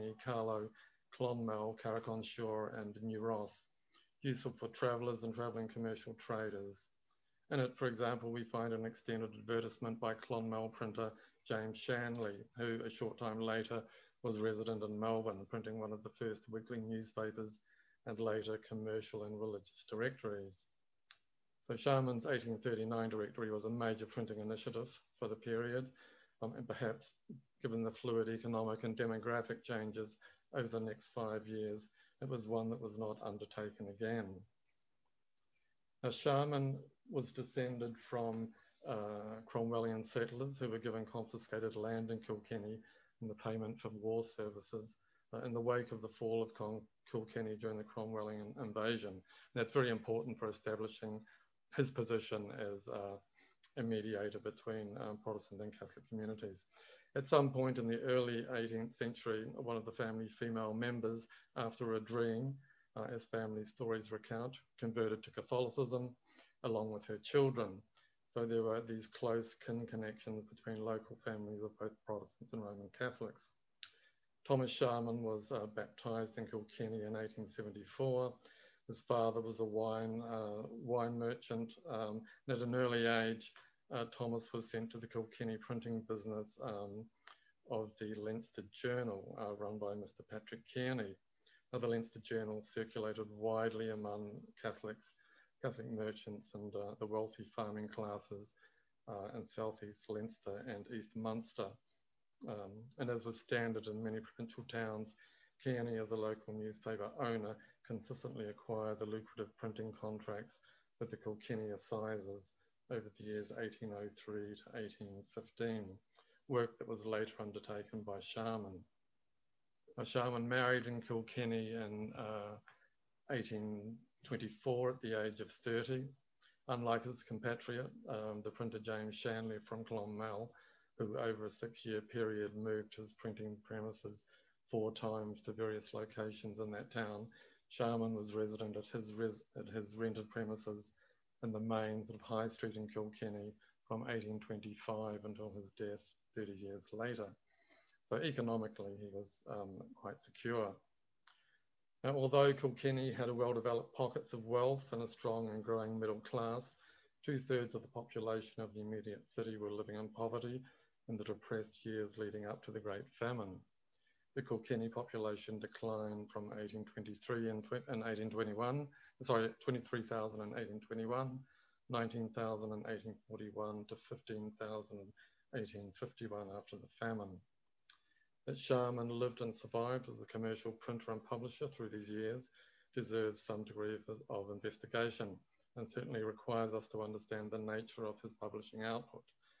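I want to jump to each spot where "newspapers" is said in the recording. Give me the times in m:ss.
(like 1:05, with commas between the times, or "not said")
0:16, 1:46.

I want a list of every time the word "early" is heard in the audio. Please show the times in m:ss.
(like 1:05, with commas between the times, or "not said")
0:57, 1:22.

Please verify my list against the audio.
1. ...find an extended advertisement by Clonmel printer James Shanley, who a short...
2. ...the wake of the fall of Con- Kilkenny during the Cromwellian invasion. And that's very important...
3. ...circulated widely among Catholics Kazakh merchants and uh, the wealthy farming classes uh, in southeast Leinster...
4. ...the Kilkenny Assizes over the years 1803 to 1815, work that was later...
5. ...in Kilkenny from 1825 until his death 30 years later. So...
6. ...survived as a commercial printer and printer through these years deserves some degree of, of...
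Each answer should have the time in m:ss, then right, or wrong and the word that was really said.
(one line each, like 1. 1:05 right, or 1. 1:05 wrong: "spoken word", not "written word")
1. 0:08 right
2. 0:45 right
3. 1:32 right
4. 1:51 right
5. 2:22 right
6. 2:59 wrong: "publisher", not "printer".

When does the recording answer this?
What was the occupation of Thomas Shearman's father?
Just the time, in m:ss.
1:20.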